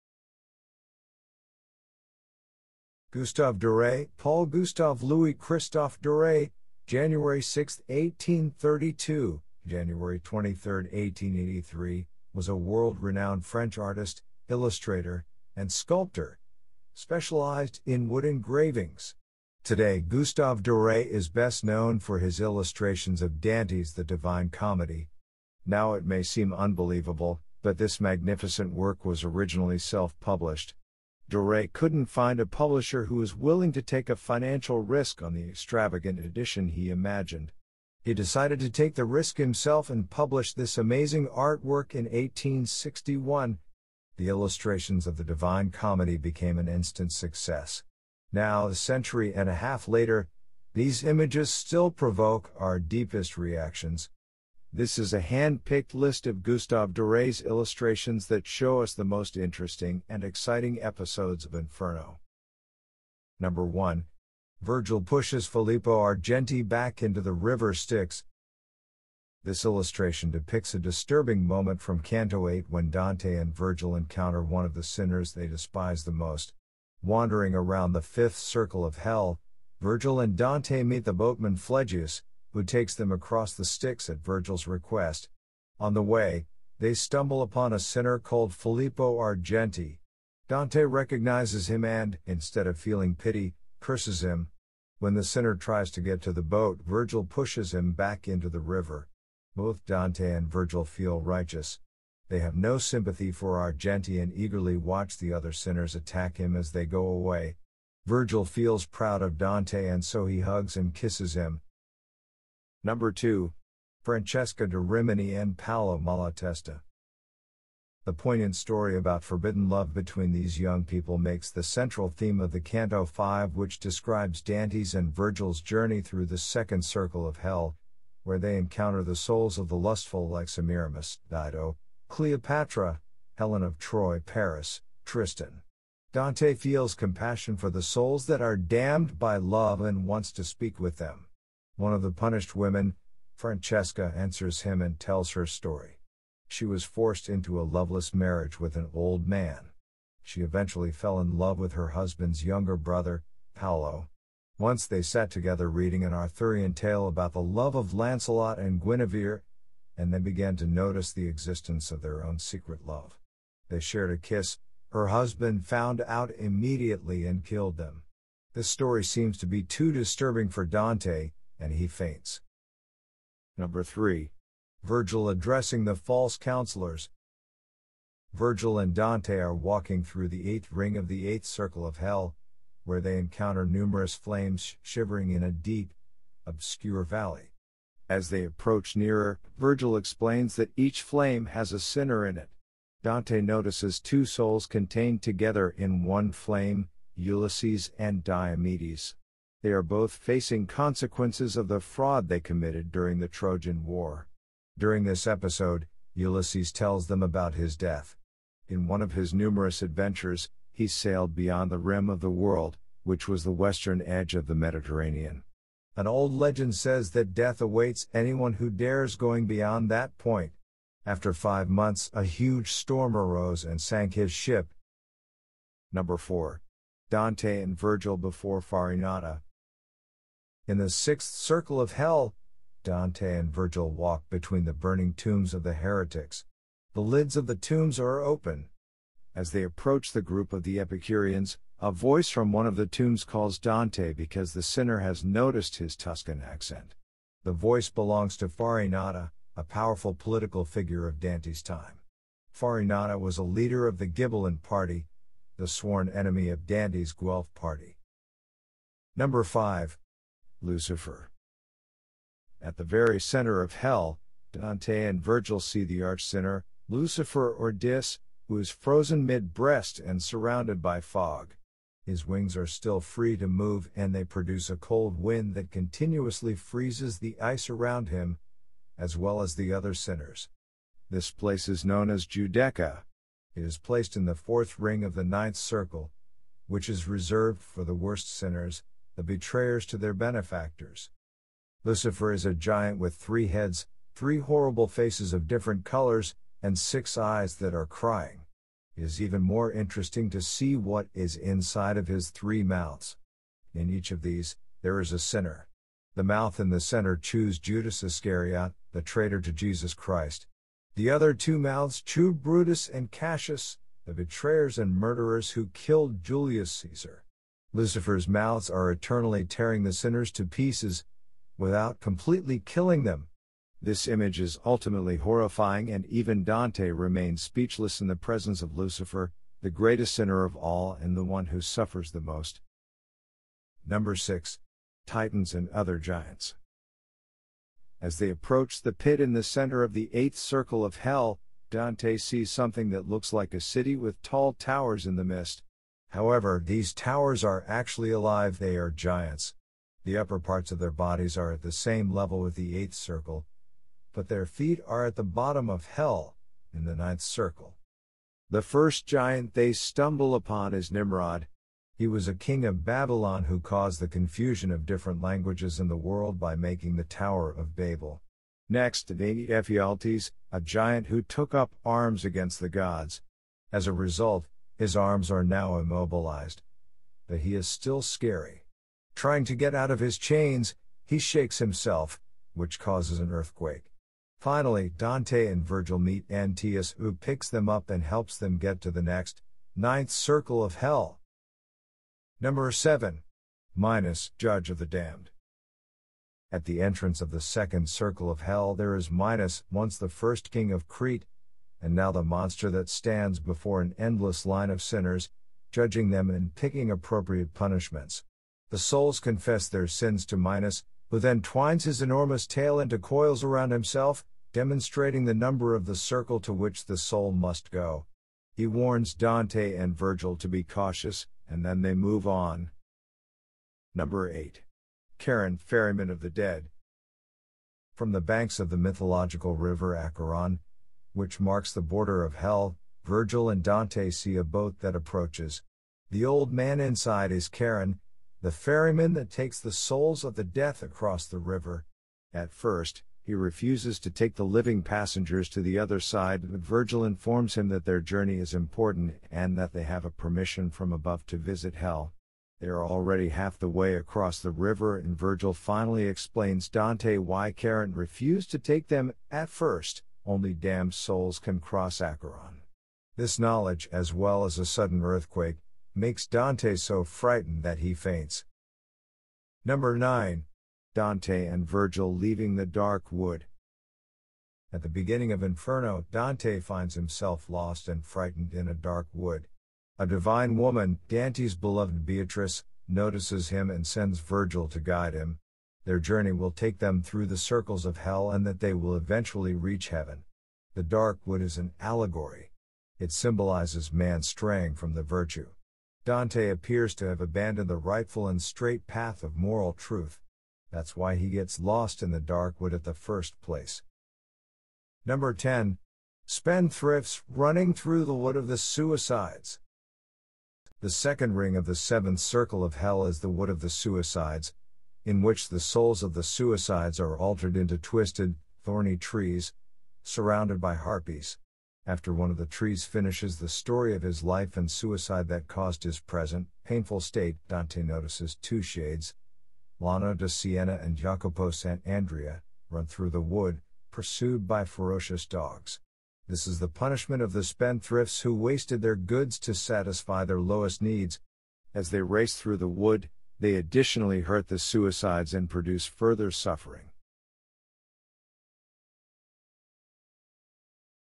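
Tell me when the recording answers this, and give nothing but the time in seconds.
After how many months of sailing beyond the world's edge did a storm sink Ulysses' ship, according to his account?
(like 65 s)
221 s.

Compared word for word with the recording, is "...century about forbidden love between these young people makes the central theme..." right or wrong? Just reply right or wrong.
wrong.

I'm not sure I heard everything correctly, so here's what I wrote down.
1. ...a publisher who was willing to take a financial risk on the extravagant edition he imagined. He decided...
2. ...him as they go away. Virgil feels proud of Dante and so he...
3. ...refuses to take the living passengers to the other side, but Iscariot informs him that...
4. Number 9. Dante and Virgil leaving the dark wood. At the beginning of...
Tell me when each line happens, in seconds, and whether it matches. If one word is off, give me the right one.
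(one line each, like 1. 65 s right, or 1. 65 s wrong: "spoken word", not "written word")
1. 32 s right
2. 106 s right
3. 443 s wrong: "Virgil", not "Iscariot"
4. 469 s right.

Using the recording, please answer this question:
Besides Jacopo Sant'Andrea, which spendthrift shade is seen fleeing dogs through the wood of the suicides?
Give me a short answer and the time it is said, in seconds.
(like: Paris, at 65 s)
Lano de Siena, at 529 s.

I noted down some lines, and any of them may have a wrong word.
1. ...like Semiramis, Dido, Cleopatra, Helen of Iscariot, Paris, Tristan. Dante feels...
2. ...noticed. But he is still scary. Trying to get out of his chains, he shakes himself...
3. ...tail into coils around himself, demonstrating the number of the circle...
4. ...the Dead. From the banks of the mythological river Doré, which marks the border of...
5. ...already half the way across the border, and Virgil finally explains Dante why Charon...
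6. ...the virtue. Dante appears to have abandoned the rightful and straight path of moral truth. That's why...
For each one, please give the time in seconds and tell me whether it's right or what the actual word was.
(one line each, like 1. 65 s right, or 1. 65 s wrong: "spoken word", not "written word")
1. 130 s wrong: "Troy", not "Iscariot"
2. 375 s wrong: "immobilized", not "noticed"
3. 412 s right
4. 426 s wrong: "Acheron", not "Doré"
5. 452 s wrong: "river", not "border"
6. 494 s right.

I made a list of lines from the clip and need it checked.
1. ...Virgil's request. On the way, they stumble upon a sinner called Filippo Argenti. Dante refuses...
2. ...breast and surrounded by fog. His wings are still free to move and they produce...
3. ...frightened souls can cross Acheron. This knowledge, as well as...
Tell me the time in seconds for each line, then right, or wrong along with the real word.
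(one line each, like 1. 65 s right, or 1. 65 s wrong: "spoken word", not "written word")
1. 84 s wrong: "recognizes", not "refuses"
2. 269 s right
3. 460 s wrong: "damned", not "frightened".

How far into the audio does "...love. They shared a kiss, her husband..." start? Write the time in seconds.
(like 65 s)
162 s.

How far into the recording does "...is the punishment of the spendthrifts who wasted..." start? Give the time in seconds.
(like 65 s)
536 s.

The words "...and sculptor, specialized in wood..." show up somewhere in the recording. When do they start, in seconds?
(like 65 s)
15 s.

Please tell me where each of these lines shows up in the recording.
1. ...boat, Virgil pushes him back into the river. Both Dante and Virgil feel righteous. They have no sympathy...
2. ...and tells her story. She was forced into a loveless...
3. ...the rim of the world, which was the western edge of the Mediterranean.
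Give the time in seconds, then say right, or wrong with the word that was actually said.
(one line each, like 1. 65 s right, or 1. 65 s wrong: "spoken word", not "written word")
1. 96 s right
2. 144 s right
3. 211 s right.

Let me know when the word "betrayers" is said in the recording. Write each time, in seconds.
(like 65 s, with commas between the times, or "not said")
289 s, 314 s.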